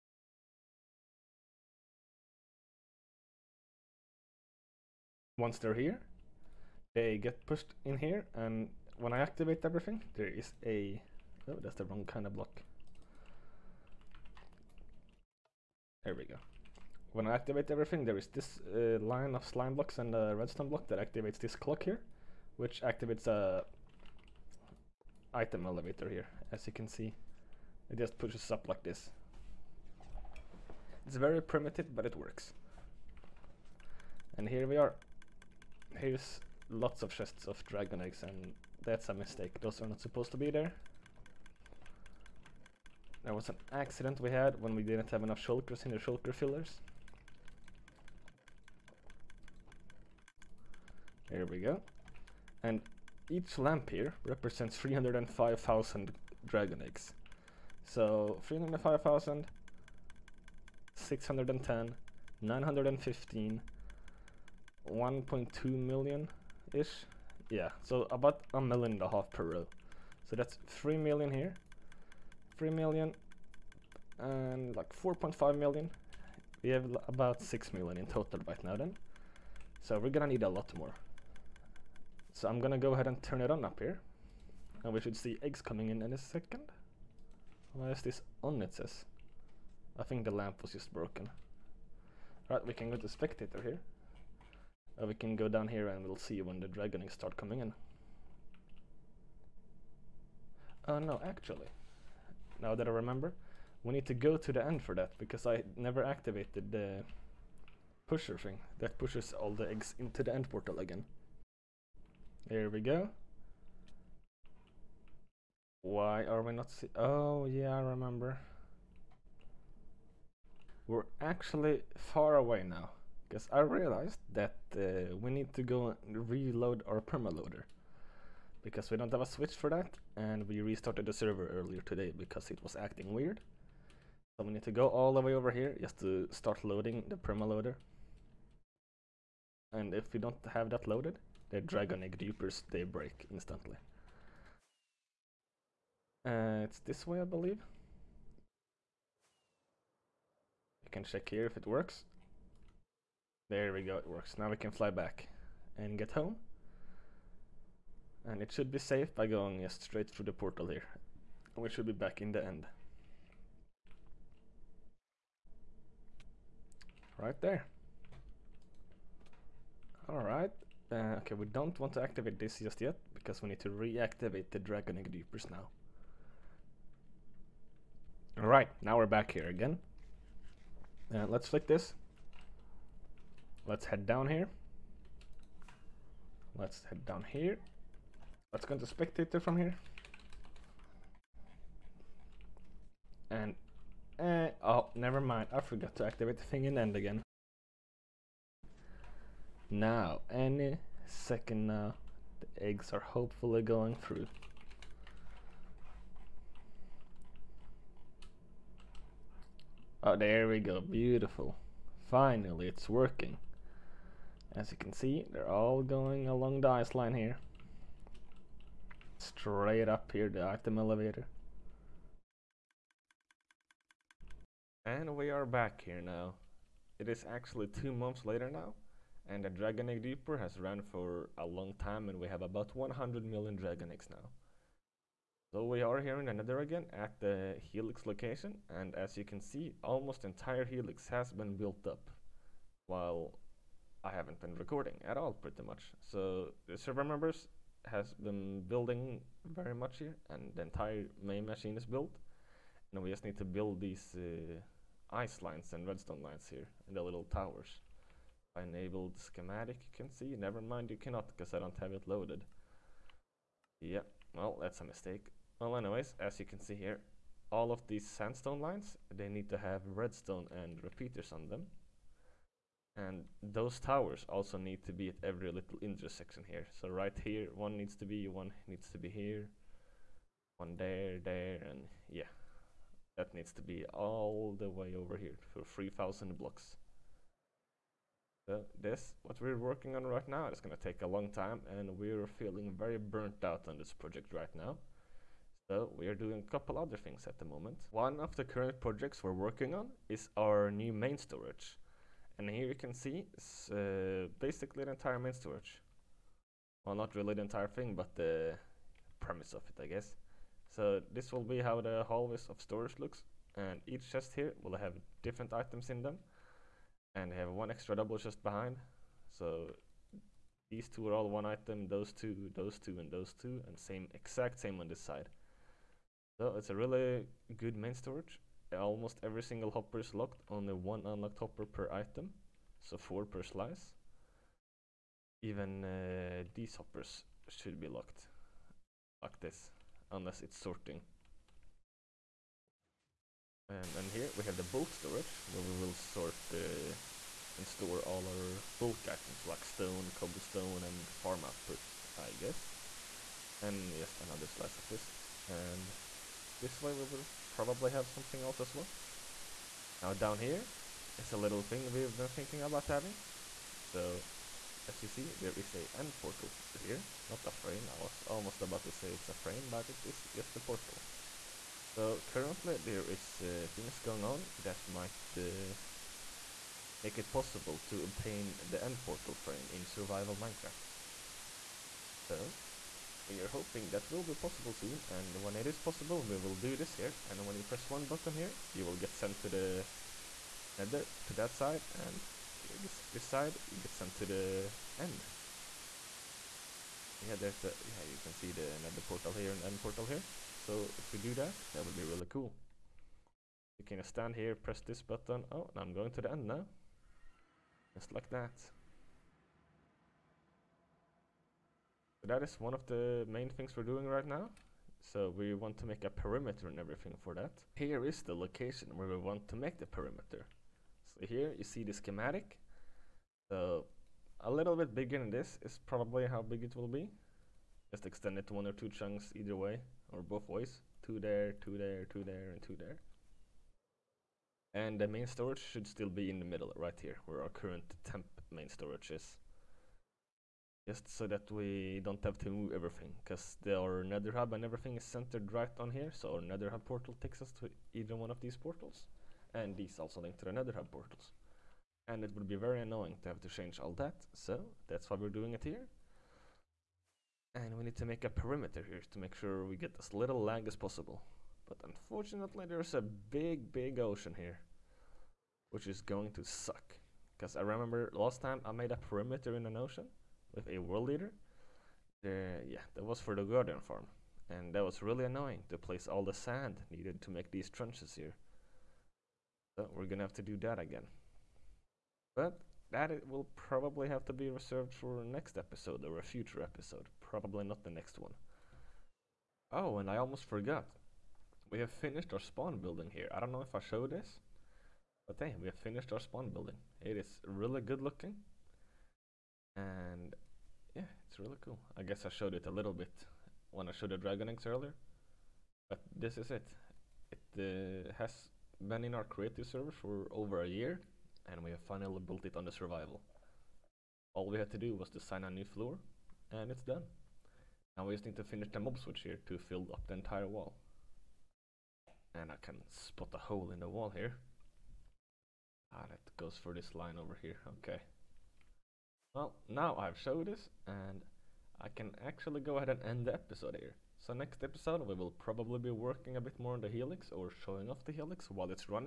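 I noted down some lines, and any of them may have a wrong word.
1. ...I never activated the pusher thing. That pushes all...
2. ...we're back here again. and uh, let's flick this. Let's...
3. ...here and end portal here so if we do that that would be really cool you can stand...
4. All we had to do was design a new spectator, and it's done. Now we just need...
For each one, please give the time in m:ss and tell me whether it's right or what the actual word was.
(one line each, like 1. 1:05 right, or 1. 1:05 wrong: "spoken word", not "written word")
1. 1:45 right
2. 2:58 right
3. 6:39 right
4. 8:34 wrong: "floor", not "spectator".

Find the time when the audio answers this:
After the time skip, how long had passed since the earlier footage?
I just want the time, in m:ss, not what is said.
3:47.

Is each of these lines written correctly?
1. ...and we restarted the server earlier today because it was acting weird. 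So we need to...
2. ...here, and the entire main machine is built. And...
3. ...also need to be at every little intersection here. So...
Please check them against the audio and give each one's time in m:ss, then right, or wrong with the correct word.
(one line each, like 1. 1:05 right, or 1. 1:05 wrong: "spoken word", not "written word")
1. 2:10 right
2. 4:09 right
3. 4:34 right.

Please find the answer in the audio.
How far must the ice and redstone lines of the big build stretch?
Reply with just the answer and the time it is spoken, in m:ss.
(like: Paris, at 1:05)
3,000 blocks, at 4:45.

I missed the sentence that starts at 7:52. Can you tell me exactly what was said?
Uh, yeah, that was for the Guardian farm.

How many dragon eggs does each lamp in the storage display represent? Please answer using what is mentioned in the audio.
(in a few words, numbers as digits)
305,000.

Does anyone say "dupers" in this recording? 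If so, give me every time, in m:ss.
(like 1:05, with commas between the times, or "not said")
2:22, 2:55.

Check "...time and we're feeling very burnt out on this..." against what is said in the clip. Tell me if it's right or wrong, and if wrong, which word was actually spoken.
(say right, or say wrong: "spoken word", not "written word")
right.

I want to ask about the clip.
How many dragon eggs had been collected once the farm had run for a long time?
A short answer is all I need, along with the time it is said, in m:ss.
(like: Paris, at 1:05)
100 million, at 3:52.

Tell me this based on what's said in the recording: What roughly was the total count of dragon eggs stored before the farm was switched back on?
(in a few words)
6 million.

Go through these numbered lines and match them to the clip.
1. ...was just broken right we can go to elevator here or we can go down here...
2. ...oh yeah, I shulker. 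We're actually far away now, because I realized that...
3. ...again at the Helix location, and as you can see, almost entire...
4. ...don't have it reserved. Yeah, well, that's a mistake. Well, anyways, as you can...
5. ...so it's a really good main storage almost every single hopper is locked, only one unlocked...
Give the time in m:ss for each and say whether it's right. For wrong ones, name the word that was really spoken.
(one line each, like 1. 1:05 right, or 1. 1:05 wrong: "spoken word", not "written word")
1. 1:30 wrong: "spectator", not "elevator"
2. 1:56 wrong: "remember", not "shulker"
3. 3:56 right
4. 4:21 wrong: "loaded", not "reserved"
5. 5:26 right.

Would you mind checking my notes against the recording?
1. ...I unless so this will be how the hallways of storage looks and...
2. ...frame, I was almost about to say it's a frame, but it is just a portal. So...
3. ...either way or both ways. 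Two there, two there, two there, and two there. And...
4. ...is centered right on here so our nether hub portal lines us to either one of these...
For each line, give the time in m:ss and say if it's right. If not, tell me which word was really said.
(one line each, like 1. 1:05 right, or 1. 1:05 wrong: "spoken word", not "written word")
1. 5:09 wrong: "guess", not "unless"
2. 6:07 right
3. 7:09 right
4. 7:24 wrong: "takes", not "lines".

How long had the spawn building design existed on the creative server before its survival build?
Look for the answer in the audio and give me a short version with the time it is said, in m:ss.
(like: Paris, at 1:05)
over a year, at 8:30.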